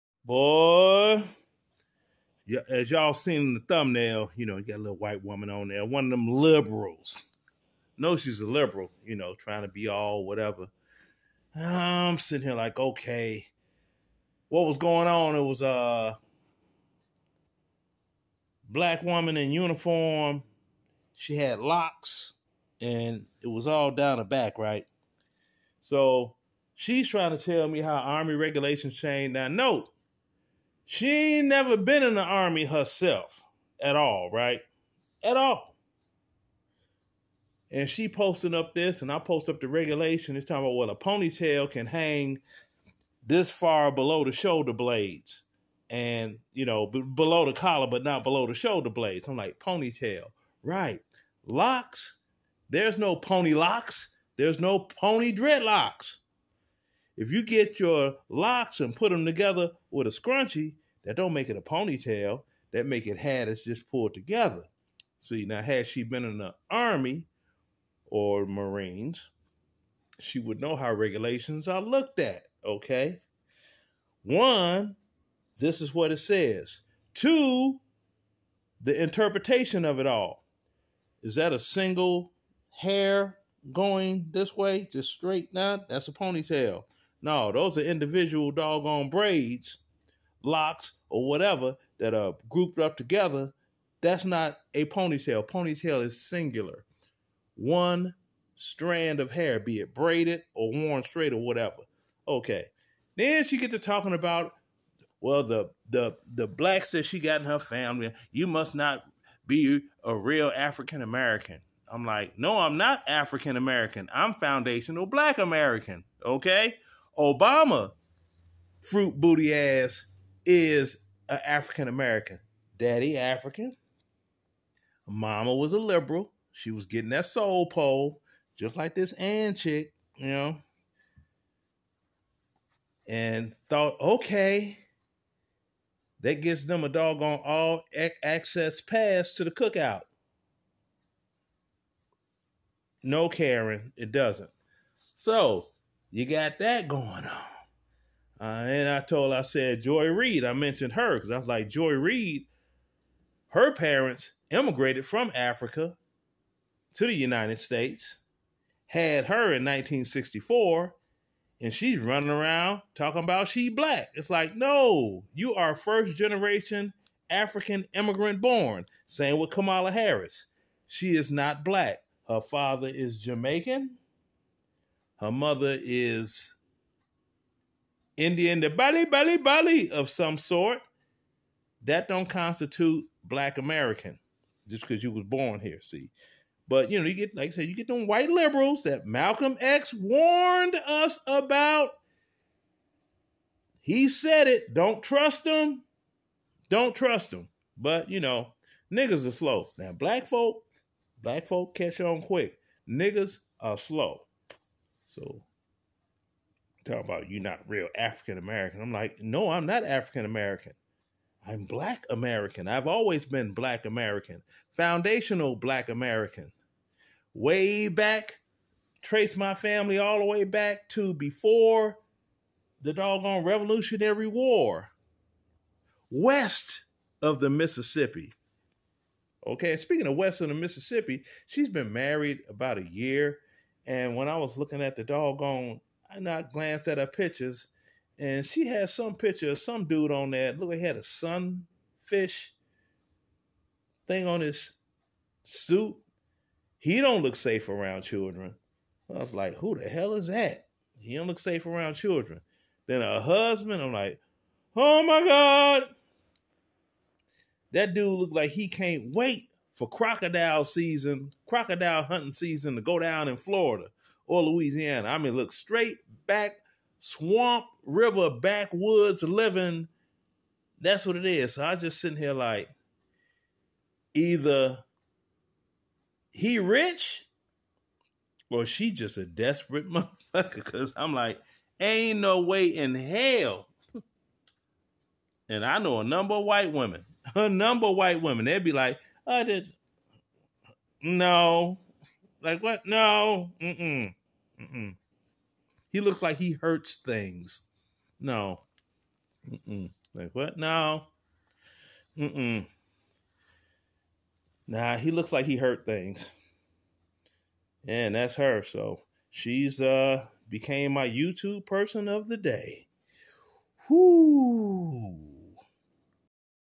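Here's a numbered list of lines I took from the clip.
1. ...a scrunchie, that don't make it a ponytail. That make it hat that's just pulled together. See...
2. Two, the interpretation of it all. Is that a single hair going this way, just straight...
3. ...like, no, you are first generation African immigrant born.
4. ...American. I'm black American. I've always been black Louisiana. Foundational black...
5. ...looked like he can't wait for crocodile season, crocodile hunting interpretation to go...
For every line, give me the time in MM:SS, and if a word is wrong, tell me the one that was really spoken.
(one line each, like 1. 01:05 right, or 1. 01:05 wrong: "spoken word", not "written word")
1. 01:00 right
2. 01:17 right
3. 02:44 right
4. 03:30 wrong: "American", not "Louisiana"
5. 04:18 wrong: "season", not "interpretation".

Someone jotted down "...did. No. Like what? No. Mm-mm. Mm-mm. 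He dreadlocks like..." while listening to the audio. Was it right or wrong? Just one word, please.
wrong.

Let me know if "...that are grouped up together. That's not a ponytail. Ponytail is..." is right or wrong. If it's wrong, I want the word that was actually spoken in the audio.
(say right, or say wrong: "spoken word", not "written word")
right.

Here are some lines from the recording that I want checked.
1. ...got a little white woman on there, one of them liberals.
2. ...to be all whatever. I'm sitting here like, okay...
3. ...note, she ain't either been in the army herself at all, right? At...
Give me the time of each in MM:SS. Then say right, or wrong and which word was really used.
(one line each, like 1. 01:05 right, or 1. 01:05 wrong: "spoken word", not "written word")
1. 00:04 right
2. 00:09 right
3. 00:29 wrong: "never", not "either".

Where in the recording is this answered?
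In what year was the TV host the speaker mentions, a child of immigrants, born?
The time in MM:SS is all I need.
02:39.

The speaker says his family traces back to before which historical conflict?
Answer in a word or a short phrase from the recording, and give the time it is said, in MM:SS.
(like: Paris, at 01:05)
Revolutionary War, at 03:43.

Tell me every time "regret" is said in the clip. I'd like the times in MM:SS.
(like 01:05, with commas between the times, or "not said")
not said.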